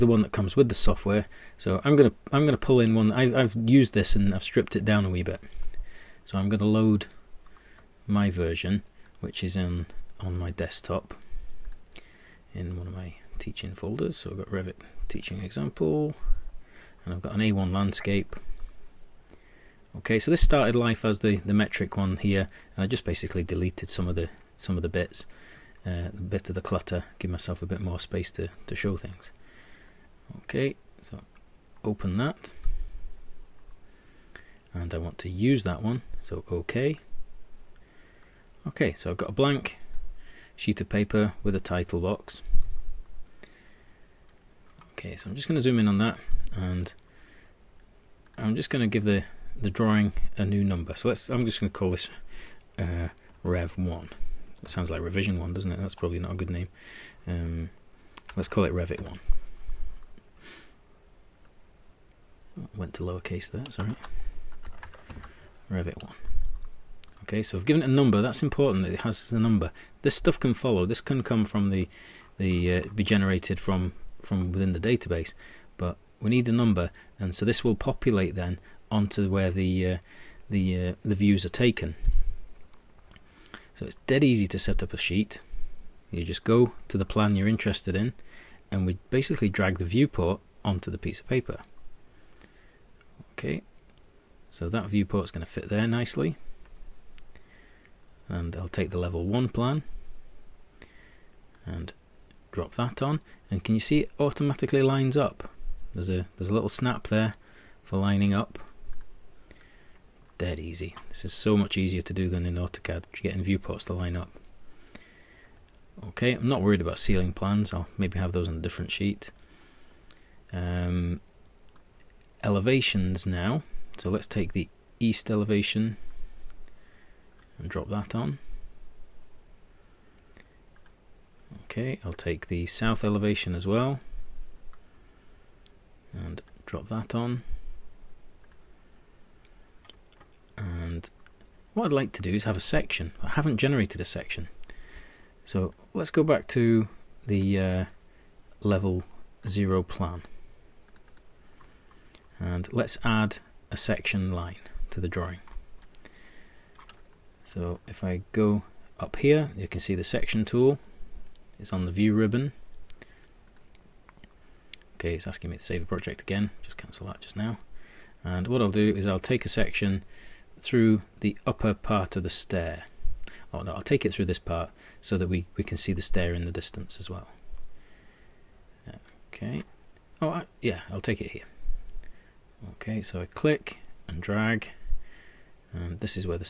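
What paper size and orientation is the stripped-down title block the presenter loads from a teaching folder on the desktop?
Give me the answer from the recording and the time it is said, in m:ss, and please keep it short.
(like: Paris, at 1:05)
A1 landscape, at 0:17.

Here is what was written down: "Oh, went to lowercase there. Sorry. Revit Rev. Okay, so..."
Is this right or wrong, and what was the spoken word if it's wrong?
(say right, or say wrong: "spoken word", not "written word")
wrong: "One", not "Rev".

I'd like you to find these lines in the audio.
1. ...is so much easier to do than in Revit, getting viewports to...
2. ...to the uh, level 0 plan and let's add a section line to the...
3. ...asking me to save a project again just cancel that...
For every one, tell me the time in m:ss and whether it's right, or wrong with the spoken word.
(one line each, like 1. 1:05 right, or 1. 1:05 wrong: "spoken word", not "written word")
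1. 1:51 wrong: "AutoCAD", not "Revit"
2. 2:26 right
3. 2:45 right.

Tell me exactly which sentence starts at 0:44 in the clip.
Okay, so I'm just going to zoom in on that, and I'm just going to give the the drawing a new number.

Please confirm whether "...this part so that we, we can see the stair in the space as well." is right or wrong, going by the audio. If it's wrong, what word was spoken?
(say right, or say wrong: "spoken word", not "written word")
wrong: "distance", not "space".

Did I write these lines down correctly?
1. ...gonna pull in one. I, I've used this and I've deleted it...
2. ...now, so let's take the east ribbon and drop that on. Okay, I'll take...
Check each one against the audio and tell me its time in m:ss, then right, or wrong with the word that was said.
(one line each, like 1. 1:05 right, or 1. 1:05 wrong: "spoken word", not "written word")
1. 0:02 wrong: "stripped", not "deleted"
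2. 2:03 wrong: "elevation", not "ribbon".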